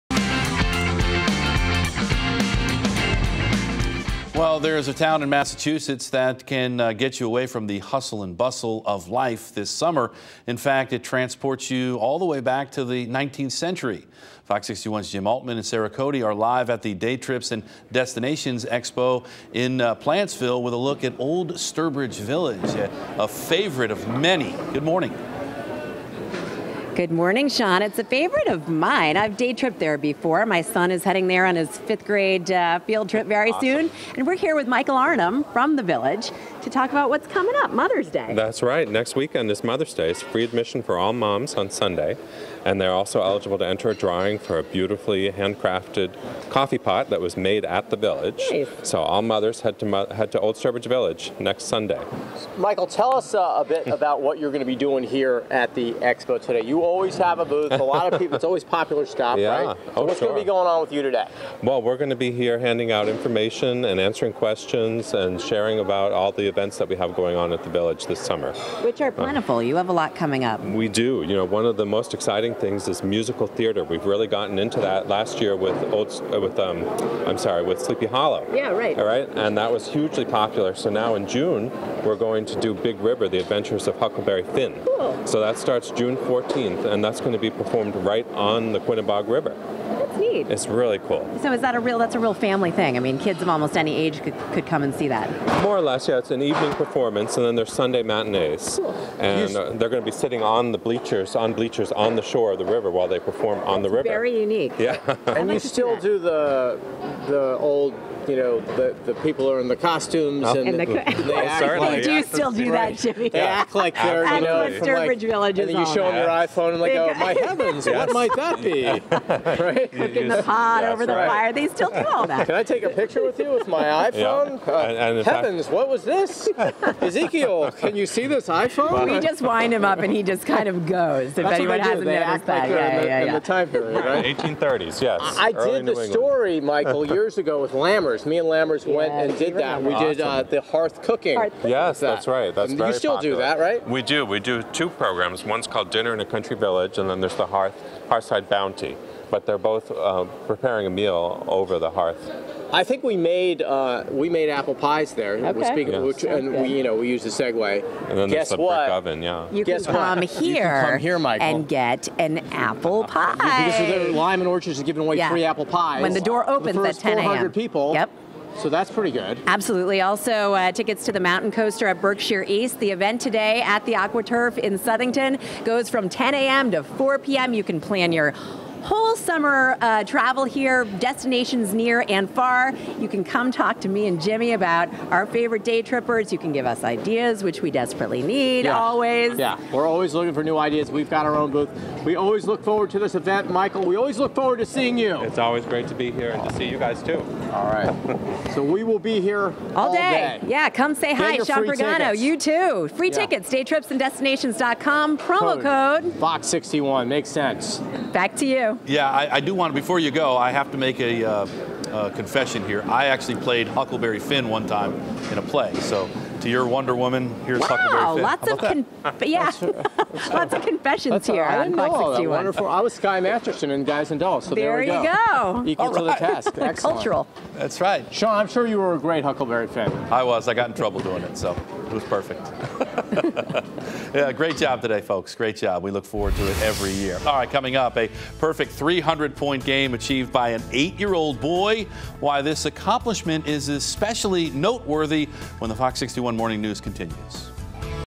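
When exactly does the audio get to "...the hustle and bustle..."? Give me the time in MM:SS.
00:07.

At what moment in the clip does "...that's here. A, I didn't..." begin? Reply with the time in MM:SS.
03:41.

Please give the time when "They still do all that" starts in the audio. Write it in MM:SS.
02:01.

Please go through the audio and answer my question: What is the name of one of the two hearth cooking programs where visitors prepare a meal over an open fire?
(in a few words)
Dinner in a Country Village.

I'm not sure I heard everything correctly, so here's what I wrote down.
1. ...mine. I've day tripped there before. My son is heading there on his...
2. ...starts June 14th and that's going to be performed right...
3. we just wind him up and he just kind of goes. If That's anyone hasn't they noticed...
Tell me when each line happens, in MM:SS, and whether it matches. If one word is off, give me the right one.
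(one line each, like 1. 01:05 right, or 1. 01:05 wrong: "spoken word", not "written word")
1. 00:28 right
2. 01:25 right
3. 02:09 right.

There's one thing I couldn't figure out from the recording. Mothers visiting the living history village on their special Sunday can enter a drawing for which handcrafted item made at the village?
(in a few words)
coffee pot.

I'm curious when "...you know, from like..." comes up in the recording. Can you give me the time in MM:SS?
01:54.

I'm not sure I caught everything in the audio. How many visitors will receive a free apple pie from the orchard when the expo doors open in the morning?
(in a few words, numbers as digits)
400.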